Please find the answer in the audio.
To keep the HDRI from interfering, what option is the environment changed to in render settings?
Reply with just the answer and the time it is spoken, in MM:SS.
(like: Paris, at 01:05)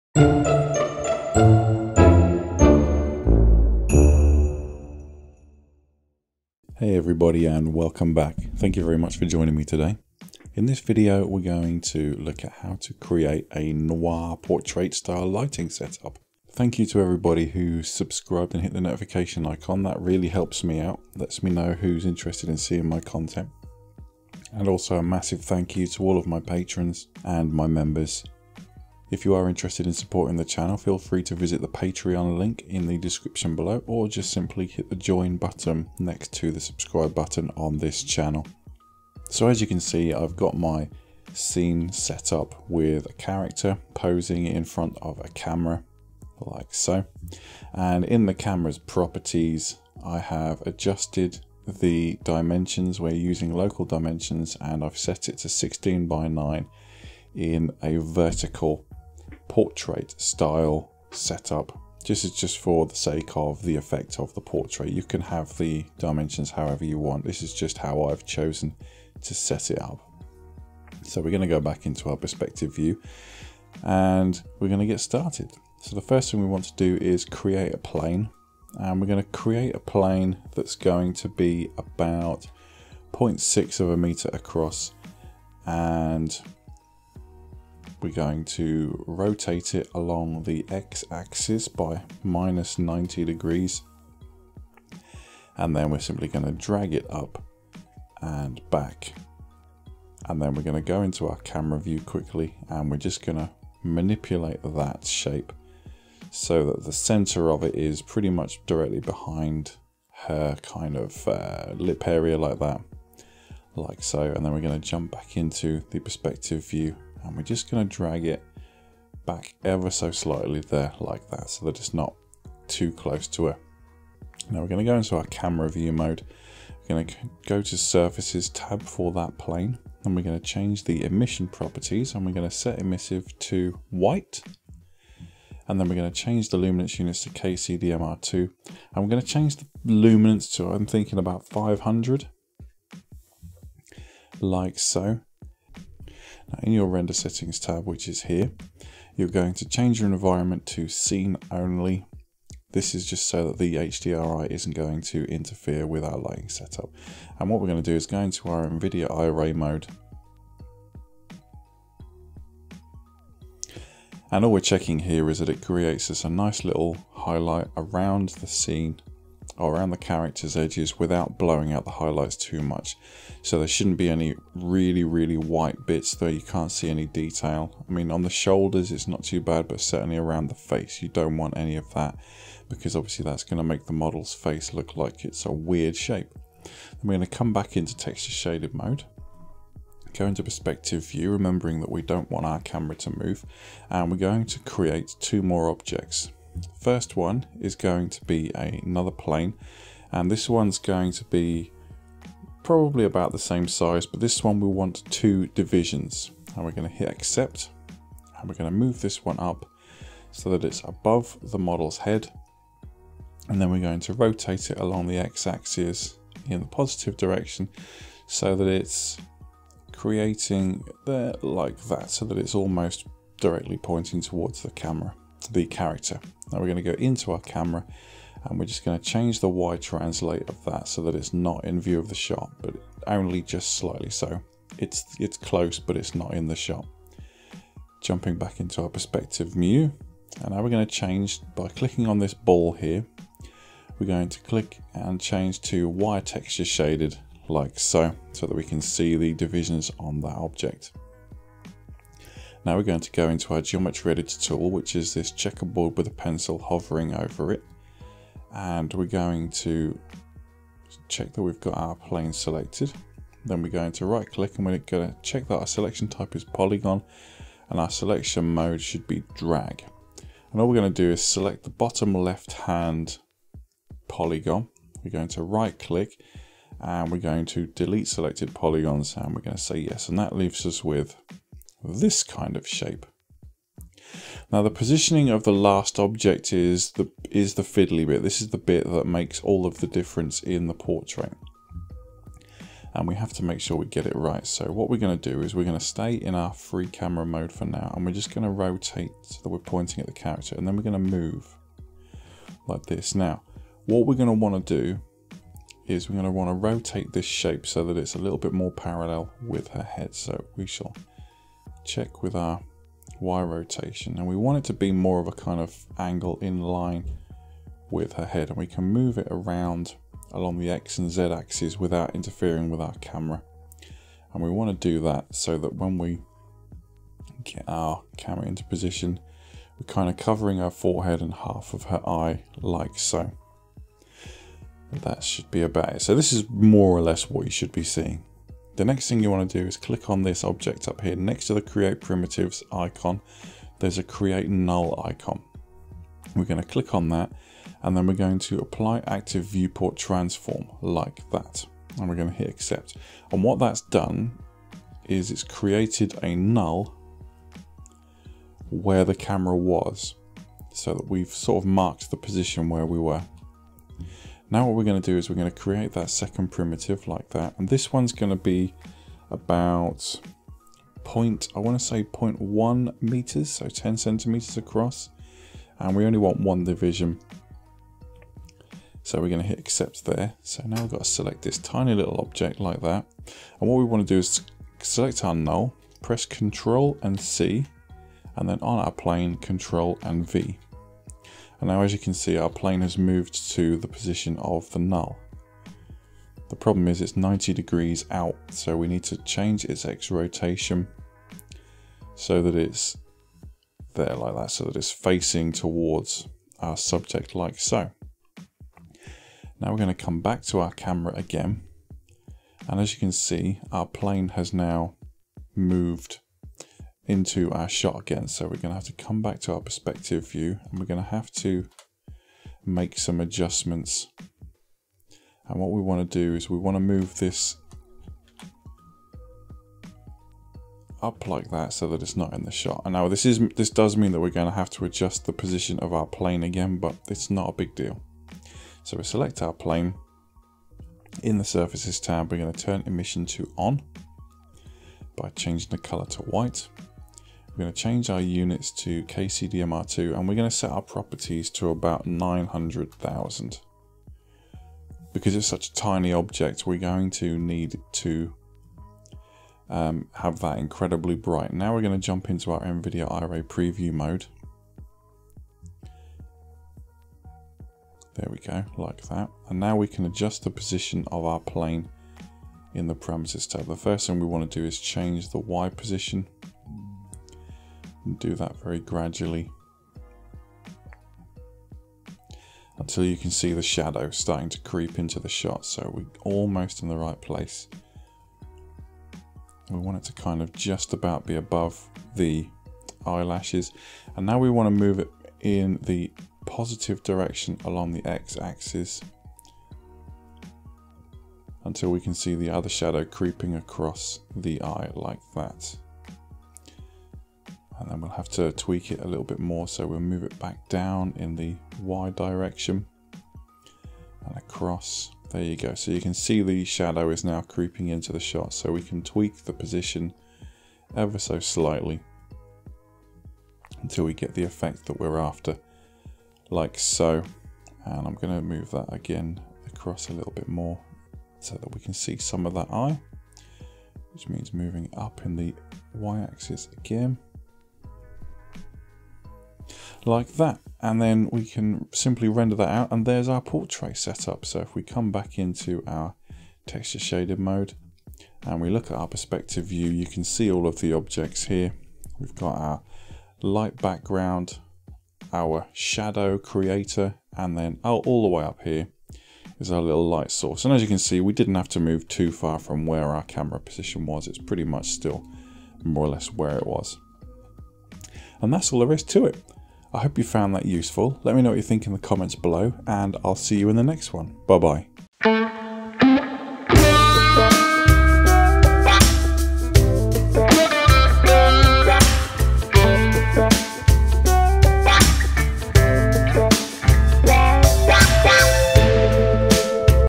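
scene only, at 02:30.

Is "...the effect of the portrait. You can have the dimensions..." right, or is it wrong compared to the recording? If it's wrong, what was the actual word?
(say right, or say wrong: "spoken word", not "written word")
right.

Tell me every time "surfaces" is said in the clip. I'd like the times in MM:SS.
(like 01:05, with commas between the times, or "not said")
02:07, 07:21.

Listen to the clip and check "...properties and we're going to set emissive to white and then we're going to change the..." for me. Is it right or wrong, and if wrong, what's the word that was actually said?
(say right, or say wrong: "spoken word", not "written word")
right.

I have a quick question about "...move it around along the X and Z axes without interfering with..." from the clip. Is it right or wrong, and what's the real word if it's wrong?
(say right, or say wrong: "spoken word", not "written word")
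right.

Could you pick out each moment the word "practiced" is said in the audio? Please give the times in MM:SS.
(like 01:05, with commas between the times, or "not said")
not said.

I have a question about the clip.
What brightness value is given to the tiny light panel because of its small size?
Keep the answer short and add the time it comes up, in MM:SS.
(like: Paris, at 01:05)
900,000, at 07:32.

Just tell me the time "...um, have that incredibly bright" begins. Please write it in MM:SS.
07:39.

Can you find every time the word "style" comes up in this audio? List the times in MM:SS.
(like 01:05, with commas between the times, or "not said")
00:14, 01:00.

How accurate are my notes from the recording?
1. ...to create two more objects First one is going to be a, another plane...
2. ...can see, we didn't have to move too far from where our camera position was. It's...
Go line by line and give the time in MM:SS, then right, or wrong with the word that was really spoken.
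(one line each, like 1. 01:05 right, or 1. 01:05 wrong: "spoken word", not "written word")
1. 03:14 right
2. 09:20 right.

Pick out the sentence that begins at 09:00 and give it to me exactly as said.
And then we can simply render that out and there's our portrait setup.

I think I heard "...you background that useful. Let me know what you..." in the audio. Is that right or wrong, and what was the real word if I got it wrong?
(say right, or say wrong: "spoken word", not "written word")
wrong: "found", not "background".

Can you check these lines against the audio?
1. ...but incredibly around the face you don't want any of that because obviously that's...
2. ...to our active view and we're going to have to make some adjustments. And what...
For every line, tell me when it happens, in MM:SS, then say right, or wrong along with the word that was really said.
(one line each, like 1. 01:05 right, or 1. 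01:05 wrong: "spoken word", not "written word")
1. 02:59 wrong: "certainly", not "incredibly"
2. 06:59 wrong: "perspective", not "active".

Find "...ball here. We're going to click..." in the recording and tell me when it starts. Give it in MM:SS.
04:02.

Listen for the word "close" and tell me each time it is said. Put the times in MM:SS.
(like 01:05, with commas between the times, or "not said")
02:02, 03:55.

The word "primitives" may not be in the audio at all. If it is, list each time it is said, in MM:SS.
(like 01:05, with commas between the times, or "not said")
05:42, 06:06.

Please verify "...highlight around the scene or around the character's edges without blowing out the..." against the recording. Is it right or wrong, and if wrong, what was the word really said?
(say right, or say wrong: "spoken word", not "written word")
right.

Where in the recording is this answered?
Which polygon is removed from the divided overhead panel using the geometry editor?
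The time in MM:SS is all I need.
04:31.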